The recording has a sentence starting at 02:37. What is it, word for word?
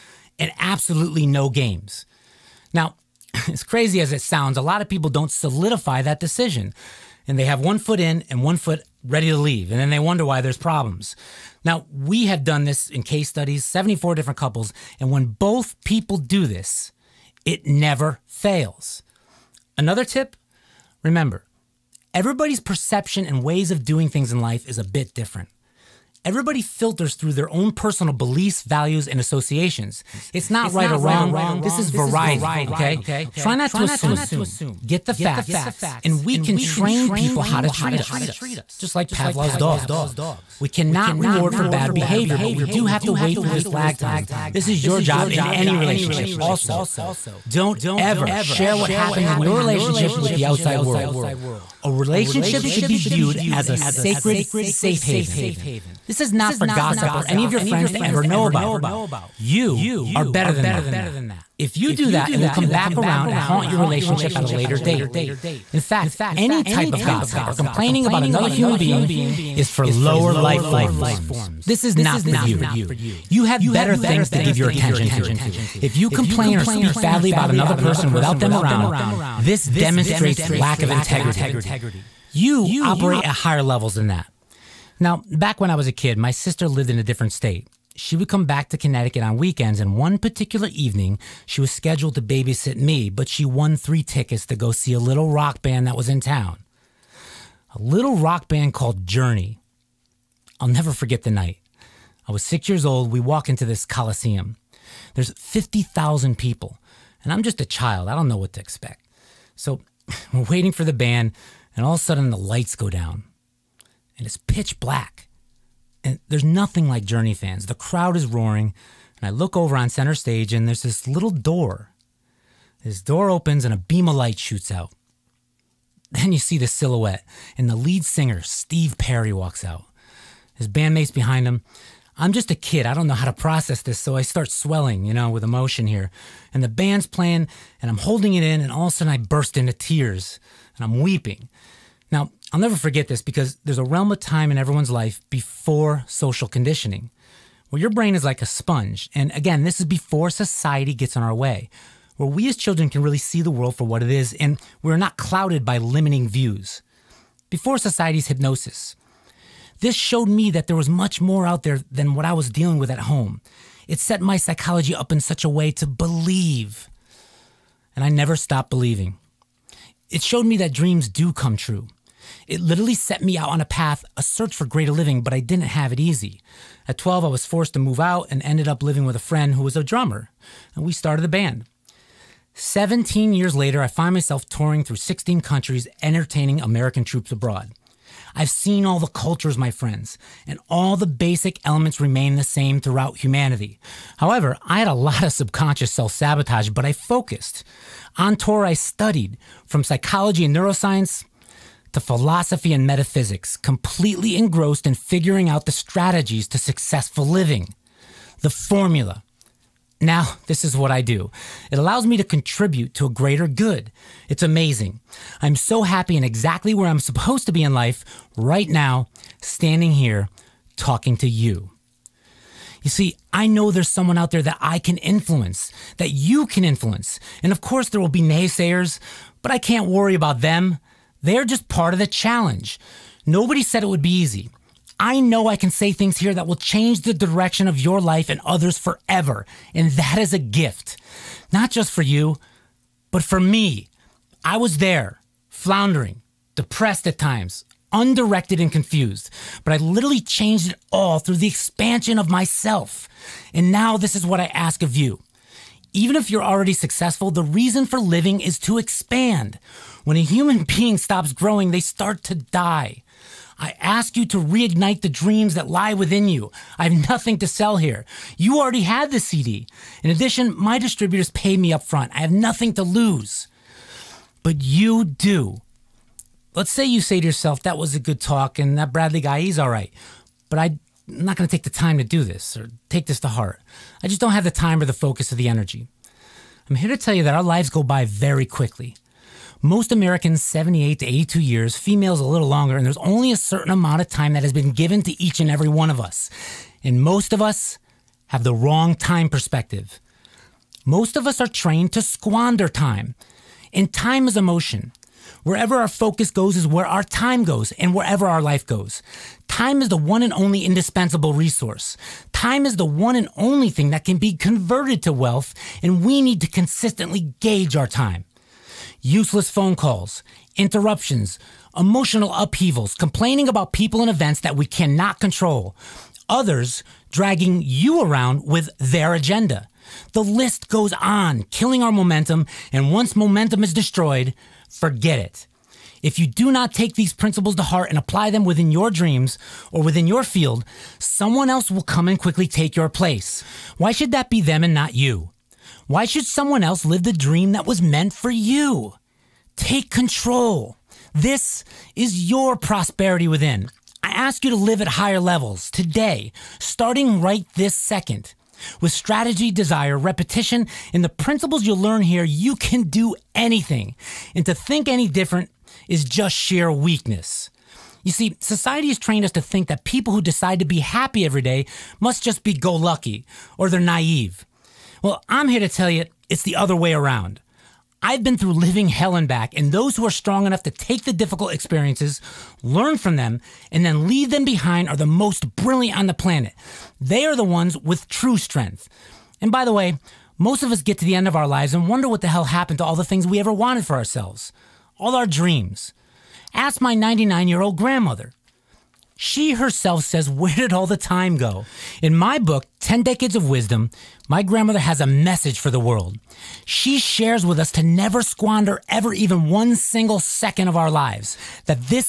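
Before society's hypnosis, this showed me that there was much more out there than what I was dealing with at home.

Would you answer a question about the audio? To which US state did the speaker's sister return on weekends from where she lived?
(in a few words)
Connecticut.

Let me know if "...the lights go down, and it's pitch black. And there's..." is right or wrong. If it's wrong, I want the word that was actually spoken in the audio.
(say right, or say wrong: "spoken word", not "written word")
right.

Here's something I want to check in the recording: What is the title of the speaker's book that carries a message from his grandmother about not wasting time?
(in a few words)
10 Decades of Wisdom.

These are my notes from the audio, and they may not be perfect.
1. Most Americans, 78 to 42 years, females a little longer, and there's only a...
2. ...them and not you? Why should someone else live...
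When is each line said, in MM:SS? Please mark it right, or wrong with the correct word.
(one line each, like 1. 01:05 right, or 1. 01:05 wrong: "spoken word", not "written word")
1. 04:49 wrong: "82", not "42"
2. 05:44 right.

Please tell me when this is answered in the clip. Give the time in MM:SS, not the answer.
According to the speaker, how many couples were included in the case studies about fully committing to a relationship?
00:13.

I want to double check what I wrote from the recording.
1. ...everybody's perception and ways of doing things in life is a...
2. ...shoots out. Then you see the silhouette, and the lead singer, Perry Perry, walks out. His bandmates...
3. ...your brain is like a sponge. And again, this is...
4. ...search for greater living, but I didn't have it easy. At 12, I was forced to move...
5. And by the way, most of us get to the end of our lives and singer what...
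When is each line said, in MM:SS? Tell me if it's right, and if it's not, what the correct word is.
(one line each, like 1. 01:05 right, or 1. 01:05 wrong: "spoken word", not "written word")
1. 00:22 right
2. 02:04 wrong: "Steve", not "Perry"
3. 02:27 right
4. 02:54 right
5. 06:29 wrong: "wonder", not "singer".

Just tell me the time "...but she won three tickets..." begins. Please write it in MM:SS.
01:33.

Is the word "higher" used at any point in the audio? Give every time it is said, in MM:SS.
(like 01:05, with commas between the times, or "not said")
01:23, 05:54.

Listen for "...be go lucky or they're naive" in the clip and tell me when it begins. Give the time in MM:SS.
06:12.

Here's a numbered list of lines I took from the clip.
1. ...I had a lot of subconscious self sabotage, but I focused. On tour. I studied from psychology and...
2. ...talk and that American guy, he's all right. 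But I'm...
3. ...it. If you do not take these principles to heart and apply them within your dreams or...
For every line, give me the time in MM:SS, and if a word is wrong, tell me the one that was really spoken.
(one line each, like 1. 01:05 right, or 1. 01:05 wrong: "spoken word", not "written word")
1. 03:14 right
2. 04:38 wrong: "Bradley", not "American"
3. 05:35 right.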